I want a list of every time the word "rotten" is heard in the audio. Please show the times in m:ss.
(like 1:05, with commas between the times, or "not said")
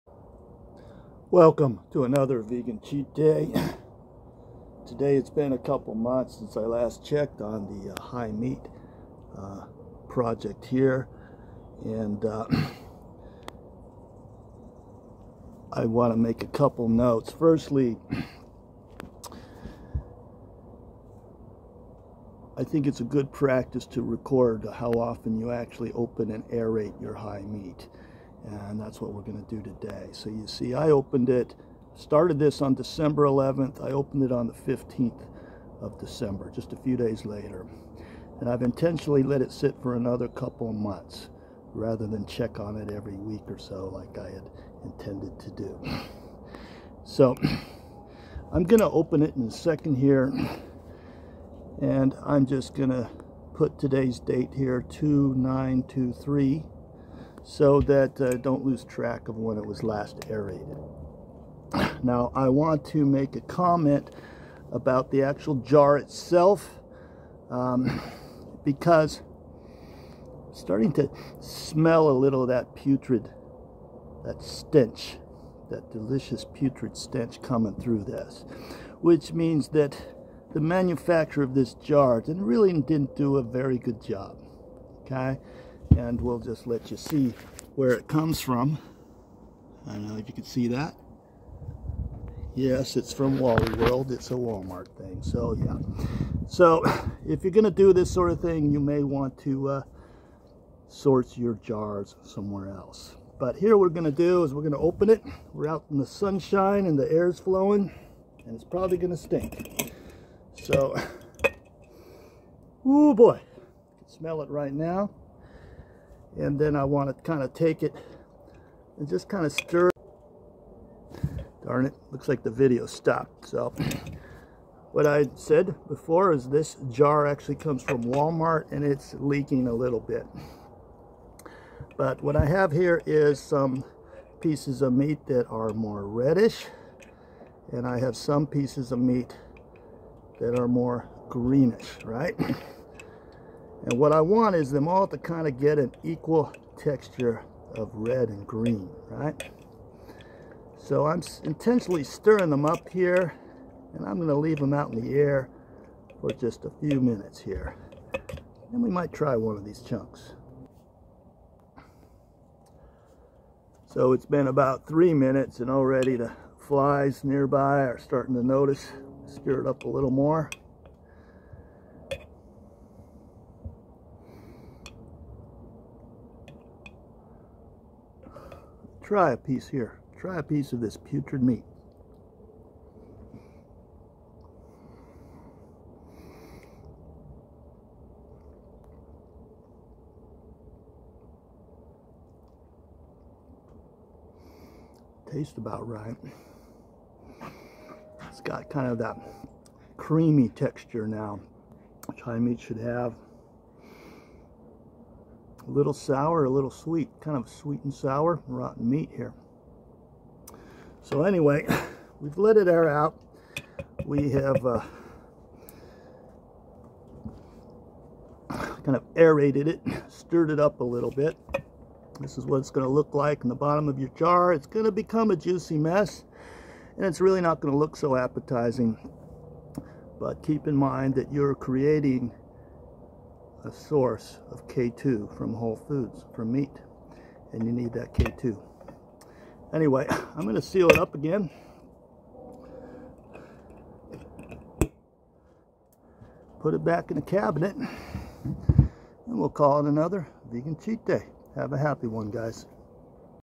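3:28.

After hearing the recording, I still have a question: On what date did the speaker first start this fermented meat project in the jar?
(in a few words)
December 11th.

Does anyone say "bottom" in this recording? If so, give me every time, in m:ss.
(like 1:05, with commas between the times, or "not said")
3:43.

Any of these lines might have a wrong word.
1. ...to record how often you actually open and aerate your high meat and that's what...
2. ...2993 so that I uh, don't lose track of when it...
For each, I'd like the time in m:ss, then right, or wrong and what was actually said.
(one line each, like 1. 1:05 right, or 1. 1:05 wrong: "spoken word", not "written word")
1. 0:23 right
2. 0:54 wrong: "2923", not "2993".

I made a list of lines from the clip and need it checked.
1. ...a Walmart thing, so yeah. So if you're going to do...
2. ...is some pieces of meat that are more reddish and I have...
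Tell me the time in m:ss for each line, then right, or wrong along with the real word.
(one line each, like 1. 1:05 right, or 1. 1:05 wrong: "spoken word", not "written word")
1. 1:34 right
2. 2:13 right.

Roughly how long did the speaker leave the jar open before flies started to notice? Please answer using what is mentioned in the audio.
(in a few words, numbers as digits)
3 minutes.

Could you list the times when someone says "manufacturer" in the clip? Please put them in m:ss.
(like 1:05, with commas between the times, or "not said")
1:20.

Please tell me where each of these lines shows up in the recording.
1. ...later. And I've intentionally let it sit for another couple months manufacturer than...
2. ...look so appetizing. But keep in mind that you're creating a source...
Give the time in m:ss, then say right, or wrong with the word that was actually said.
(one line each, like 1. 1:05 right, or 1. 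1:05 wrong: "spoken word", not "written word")
1. 0:37 wrong: "rather", not "manufacturer"
2. 3:47 right.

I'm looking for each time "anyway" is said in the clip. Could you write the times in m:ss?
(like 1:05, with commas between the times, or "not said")
3:31, 3:59.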